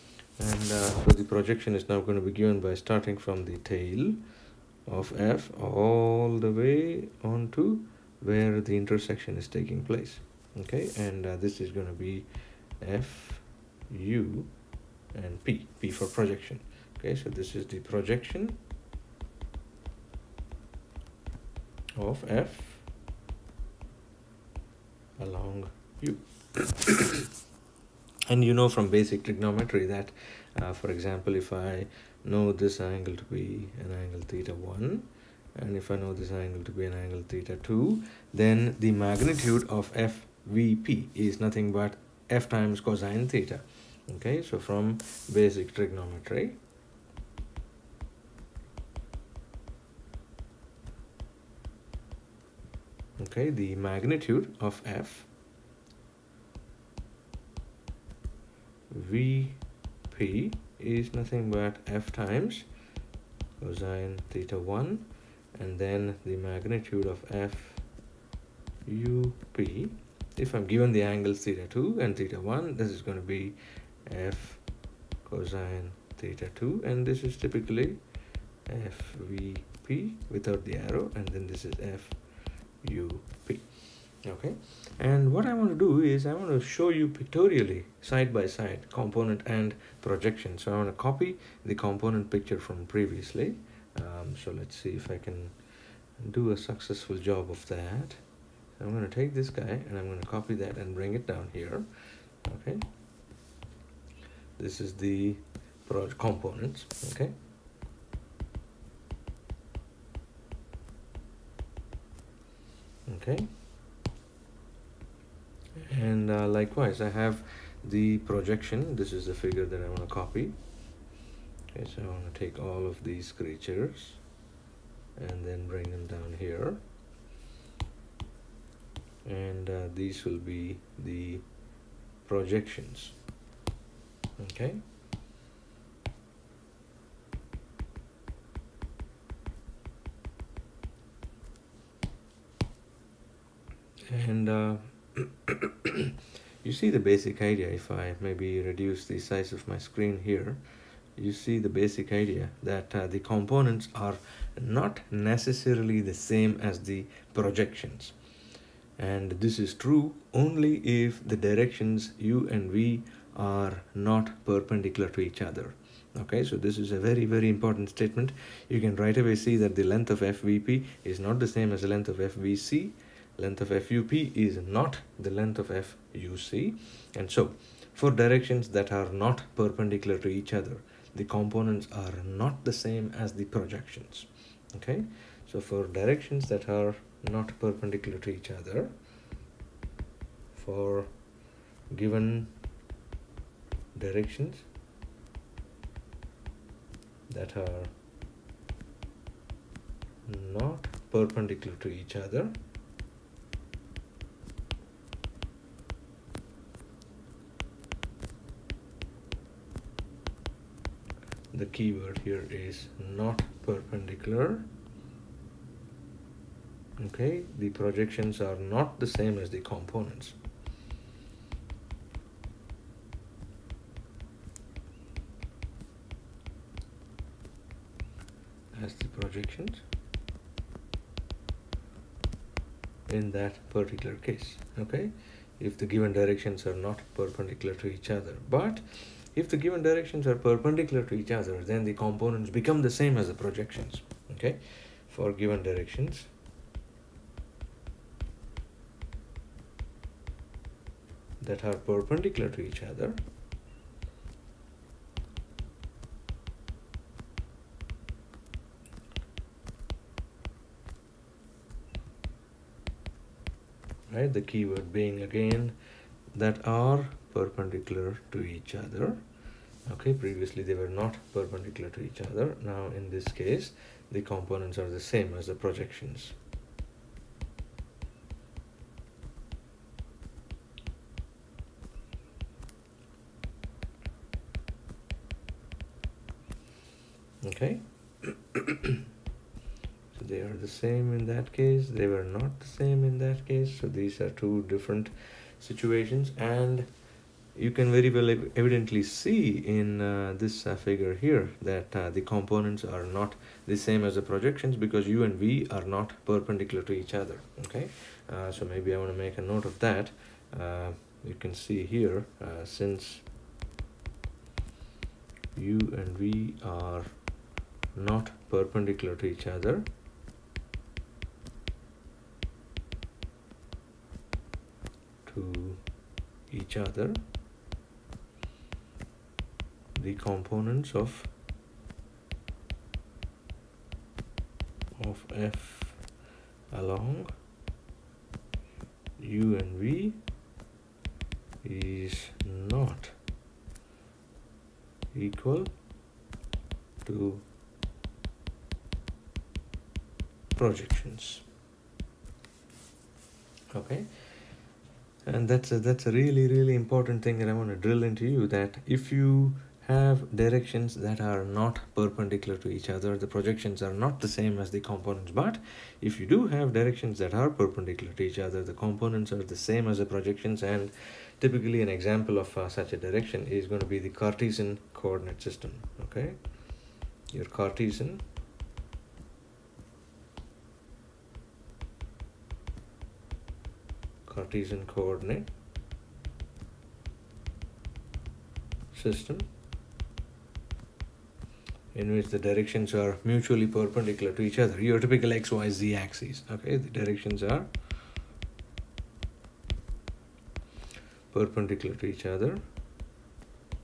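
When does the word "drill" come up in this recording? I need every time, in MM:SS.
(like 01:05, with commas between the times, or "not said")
05:57.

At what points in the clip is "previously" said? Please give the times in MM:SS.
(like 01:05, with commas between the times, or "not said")
01:32, 04:30.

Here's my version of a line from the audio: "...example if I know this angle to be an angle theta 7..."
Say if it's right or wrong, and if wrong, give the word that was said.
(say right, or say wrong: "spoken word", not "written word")
wrong: "1", not "7".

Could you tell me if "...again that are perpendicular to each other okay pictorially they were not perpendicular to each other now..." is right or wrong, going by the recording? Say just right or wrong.
wrong.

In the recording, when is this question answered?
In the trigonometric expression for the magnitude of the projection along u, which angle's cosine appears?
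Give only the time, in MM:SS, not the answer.
01:14.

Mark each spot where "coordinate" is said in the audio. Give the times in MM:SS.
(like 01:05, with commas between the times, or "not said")
06:14, 06:24.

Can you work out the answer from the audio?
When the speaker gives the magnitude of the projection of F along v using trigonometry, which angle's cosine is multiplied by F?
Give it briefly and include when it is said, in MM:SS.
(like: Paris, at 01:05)
theta 1, at 01:01.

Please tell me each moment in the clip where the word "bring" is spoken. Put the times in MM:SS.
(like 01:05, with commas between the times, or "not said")
01:40, 02:05.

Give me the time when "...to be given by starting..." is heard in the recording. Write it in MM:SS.
00:02.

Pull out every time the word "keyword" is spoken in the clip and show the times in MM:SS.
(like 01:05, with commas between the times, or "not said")
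03:31, 04:24.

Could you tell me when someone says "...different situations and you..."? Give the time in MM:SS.
04:54.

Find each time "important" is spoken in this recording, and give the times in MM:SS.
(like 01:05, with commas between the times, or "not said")
02:47, 05:56.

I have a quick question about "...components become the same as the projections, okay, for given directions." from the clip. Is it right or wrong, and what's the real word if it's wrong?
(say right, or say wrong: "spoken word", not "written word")
right.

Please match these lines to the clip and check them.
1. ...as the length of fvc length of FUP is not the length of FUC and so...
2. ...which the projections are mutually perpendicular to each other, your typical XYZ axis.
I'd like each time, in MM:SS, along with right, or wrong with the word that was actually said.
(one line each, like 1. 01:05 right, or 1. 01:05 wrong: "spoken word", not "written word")
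1. 02:51 right
2. 06:32 wrong: "directions", not "projections".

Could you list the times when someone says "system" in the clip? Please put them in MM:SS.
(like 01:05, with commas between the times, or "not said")
06:15, 06:28.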